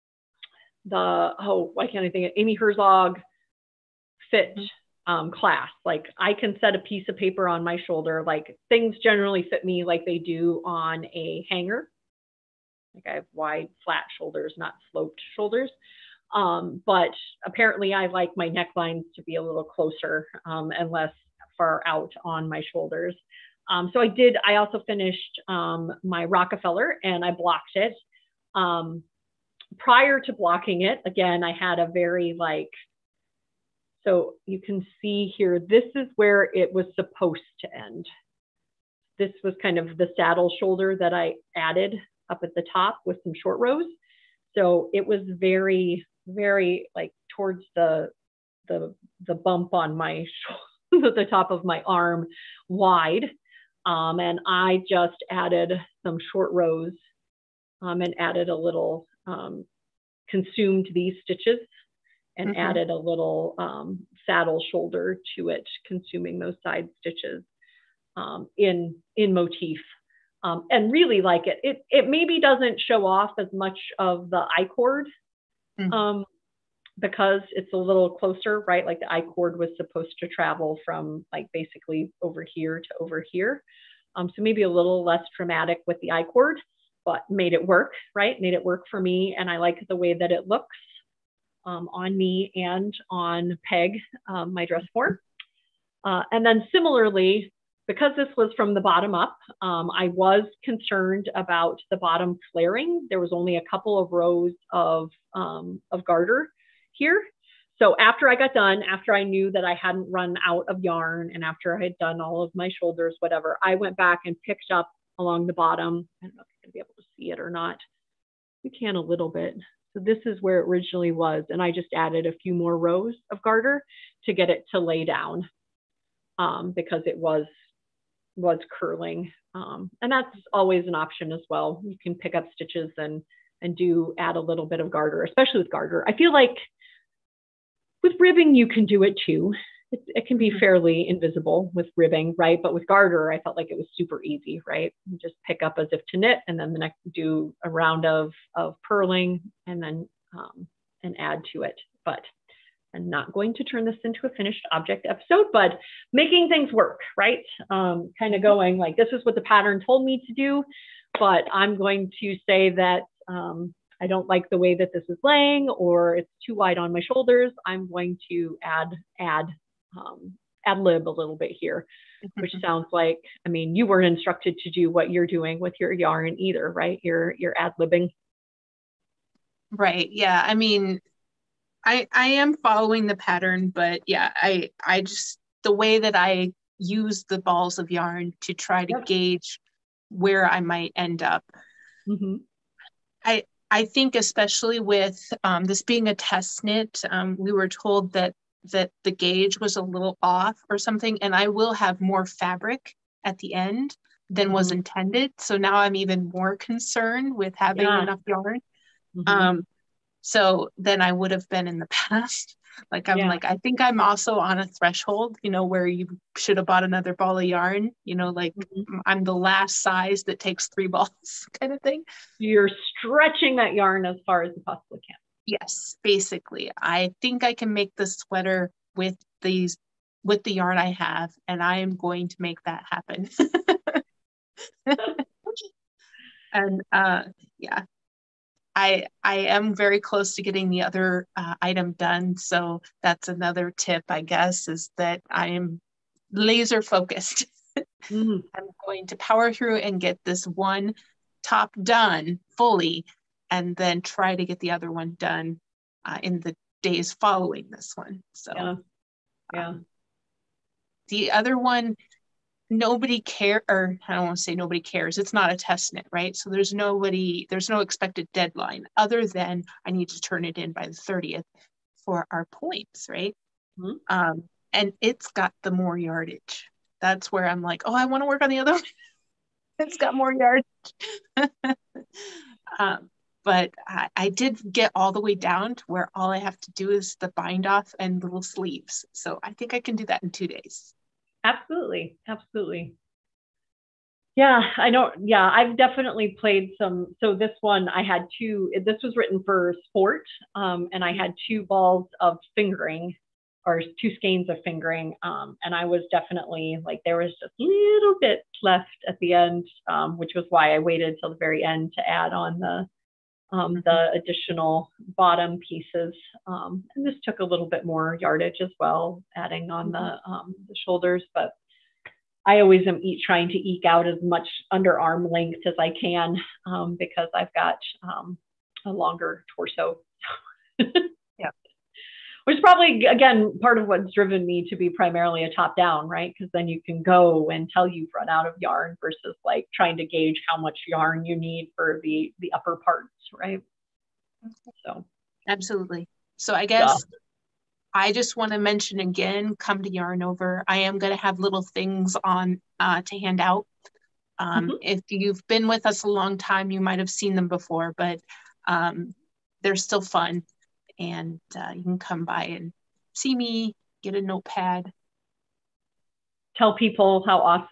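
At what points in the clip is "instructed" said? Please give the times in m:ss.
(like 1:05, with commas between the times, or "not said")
2:54.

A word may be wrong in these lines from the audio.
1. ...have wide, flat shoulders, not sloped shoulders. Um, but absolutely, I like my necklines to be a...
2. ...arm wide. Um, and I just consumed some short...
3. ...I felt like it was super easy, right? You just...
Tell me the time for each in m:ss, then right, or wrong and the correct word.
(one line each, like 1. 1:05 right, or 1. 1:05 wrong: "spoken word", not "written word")
1. 0:13 wrong: "apparently", not "absolutely"
2. 0:51 wrong: "added", not "consumed"
3. 2:23 right.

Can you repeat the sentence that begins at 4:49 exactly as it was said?
So I think I can do that in two days.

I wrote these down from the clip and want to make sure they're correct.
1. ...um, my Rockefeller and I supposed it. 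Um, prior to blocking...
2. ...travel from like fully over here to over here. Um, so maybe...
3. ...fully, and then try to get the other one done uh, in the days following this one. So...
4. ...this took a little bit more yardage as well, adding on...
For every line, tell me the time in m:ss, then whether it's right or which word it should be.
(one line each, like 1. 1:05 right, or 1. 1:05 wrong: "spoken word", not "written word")
1. 0:25 wrong: "blocked", not "supposed"
2. 1:20 wrong: "basically", not "fully"
3. 4:12 right
4. 5:17 right.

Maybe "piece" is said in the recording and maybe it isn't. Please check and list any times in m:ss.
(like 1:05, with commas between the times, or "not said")
0:06, 5:15.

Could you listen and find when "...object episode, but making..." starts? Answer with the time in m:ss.
2:34.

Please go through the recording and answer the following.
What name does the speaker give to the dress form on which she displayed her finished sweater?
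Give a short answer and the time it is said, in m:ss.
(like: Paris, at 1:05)
Peg, at 1:33.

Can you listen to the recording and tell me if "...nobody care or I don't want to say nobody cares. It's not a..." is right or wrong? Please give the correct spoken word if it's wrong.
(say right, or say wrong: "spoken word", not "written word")
right.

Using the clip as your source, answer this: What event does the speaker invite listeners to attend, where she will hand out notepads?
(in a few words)
Yarn Over.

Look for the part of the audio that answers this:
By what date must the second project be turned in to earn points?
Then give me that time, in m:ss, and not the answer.
4:30.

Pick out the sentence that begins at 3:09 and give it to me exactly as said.
gauge where I might end up.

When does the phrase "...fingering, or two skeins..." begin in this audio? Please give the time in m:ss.
5:02.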